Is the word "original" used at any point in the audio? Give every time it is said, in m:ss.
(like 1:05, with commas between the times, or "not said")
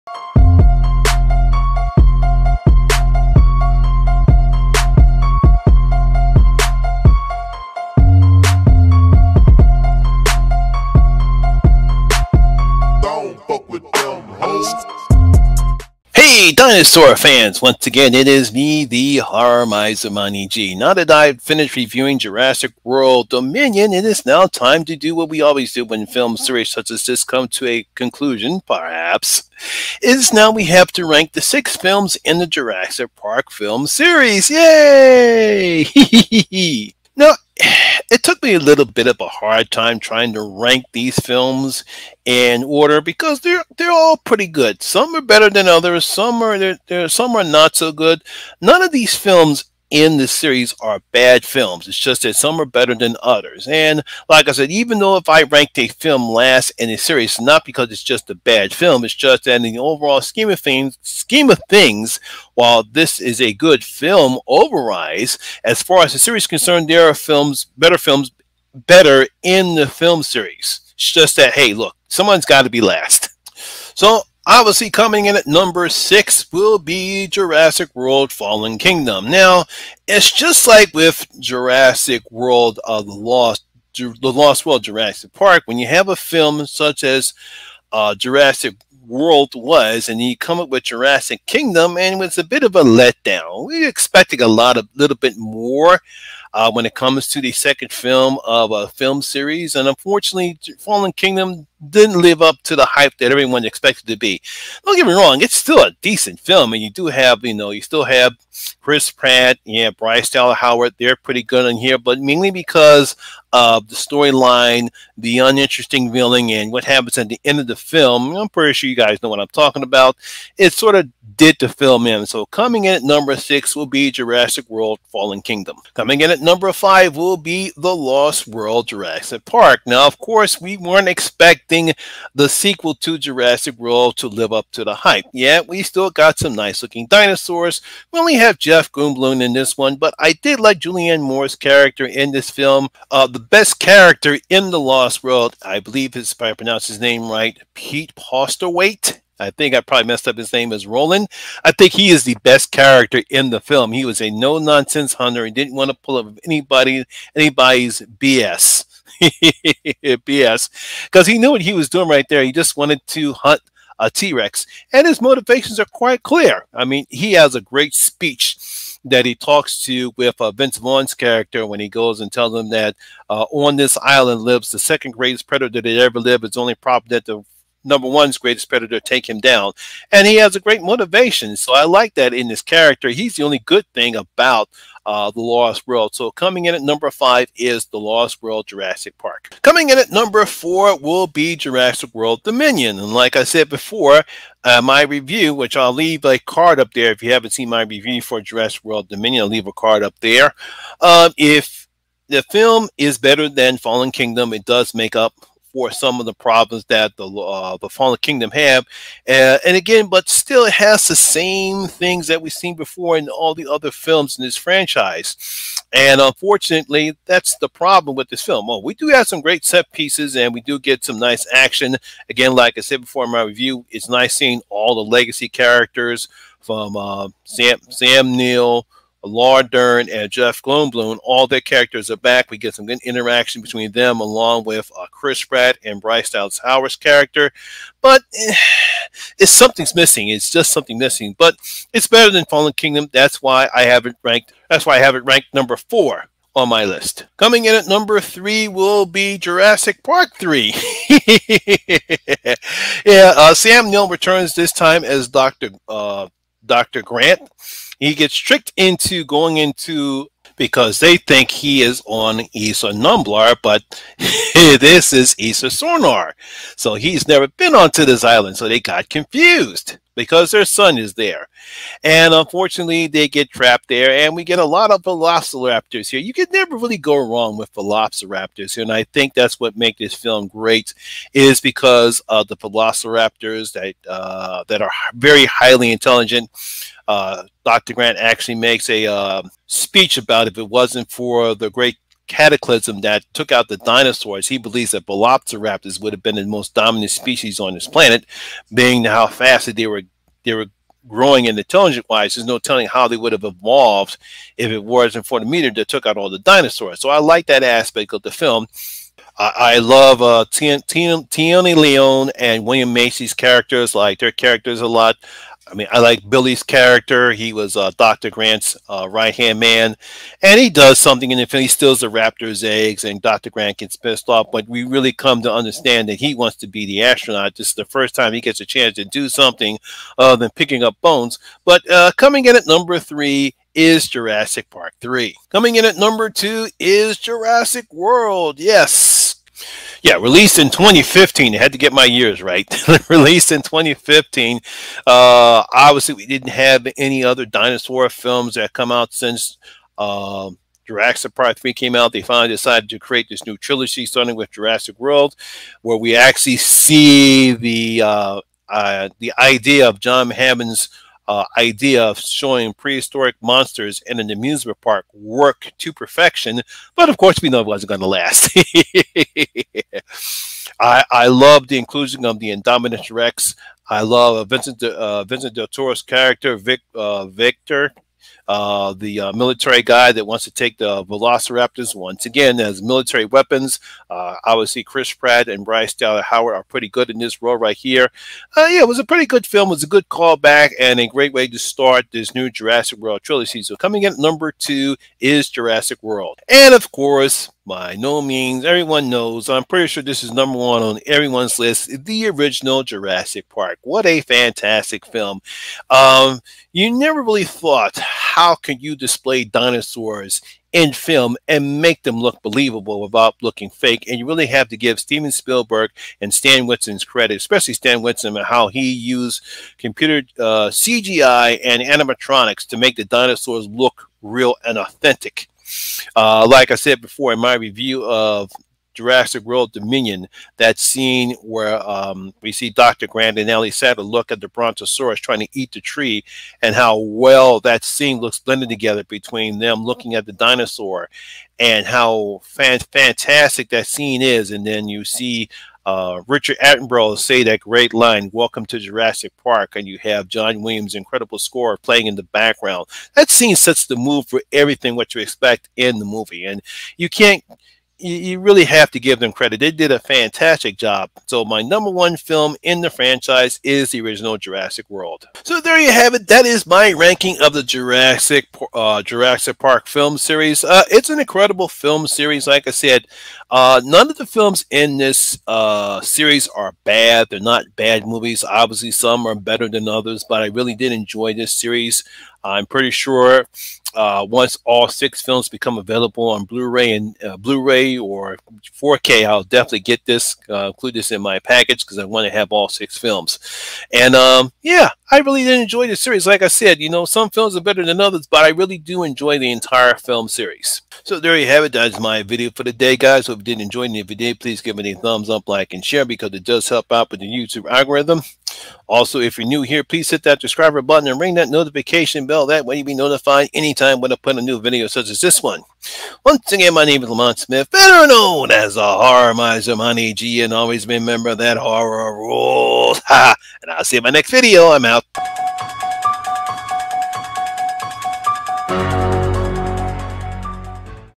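6:42, 7:44.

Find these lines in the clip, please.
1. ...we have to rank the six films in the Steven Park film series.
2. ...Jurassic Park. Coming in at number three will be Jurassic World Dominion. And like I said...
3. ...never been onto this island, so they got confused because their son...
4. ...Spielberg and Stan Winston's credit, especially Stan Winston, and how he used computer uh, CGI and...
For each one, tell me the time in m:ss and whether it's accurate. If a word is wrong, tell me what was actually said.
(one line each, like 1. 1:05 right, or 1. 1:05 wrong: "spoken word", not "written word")
1. 0:30 wrong: "Jurassic", not "Steven"
2. 3:08 wrong: "four", not "three"
3. 4:27 right
4. 6:55 right.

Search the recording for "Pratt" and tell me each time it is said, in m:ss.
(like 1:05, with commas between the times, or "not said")
1:49, 3:55, 6:25.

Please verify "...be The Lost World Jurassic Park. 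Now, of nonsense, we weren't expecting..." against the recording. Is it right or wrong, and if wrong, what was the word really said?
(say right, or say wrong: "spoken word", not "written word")
wrong: "course", not "nonsense".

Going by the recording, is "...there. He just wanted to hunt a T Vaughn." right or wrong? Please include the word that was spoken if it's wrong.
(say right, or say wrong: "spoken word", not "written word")
wrong: "Rex", not "Vaughn".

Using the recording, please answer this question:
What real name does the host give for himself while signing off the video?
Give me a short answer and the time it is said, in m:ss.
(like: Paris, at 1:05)
Lamont Smith, at 8:37.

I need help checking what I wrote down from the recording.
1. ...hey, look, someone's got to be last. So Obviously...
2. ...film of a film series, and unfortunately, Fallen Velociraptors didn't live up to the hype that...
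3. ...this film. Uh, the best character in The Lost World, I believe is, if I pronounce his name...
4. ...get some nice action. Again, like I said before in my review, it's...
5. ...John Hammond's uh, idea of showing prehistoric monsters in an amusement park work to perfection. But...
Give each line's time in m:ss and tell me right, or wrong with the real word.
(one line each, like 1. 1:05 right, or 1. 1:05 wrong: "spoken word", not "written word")
1. 1:11 right
2. 1:37 wrong: "Kingdom", not "Velociraptors"
3. 2:22 right
4. 3:40 right
5. 5:59 right.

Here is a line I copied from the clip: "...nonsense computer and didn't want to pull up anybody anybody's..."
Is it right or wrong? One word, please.
wrong.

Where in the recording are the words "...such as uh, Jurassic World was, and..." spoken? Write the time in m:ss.
1:26.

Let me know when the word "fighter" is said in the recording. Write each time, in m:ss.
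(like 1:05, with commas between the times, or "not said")
not said.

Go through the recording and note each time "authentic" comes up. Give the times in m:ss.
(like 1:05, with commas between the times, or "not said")
7:04.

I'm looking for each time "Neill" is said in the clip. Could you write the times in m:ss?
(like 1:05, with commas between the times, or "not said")
3:48, 4:13.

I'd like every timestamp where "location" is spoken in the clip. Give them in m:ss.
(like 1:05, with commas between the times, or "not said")
not said.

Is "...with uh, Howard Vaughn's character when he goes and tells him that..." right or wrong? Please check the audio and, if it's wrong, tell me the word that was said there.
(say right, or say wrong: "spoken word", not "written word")
wrong: "Vince", not "Howard".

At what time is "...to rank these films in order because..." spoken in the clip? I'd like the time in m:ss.
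0:40.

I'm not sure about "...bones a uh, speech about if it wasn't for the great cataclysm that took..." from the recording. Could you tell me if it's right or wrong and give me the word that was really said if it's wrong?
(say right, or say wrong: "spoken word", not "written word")
wrong: "makes", not "bones".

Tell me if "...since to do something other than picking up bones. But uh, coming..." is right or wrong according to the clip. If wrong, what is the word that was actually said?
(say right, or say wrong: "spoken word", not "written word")
wrong: "chance", not "since".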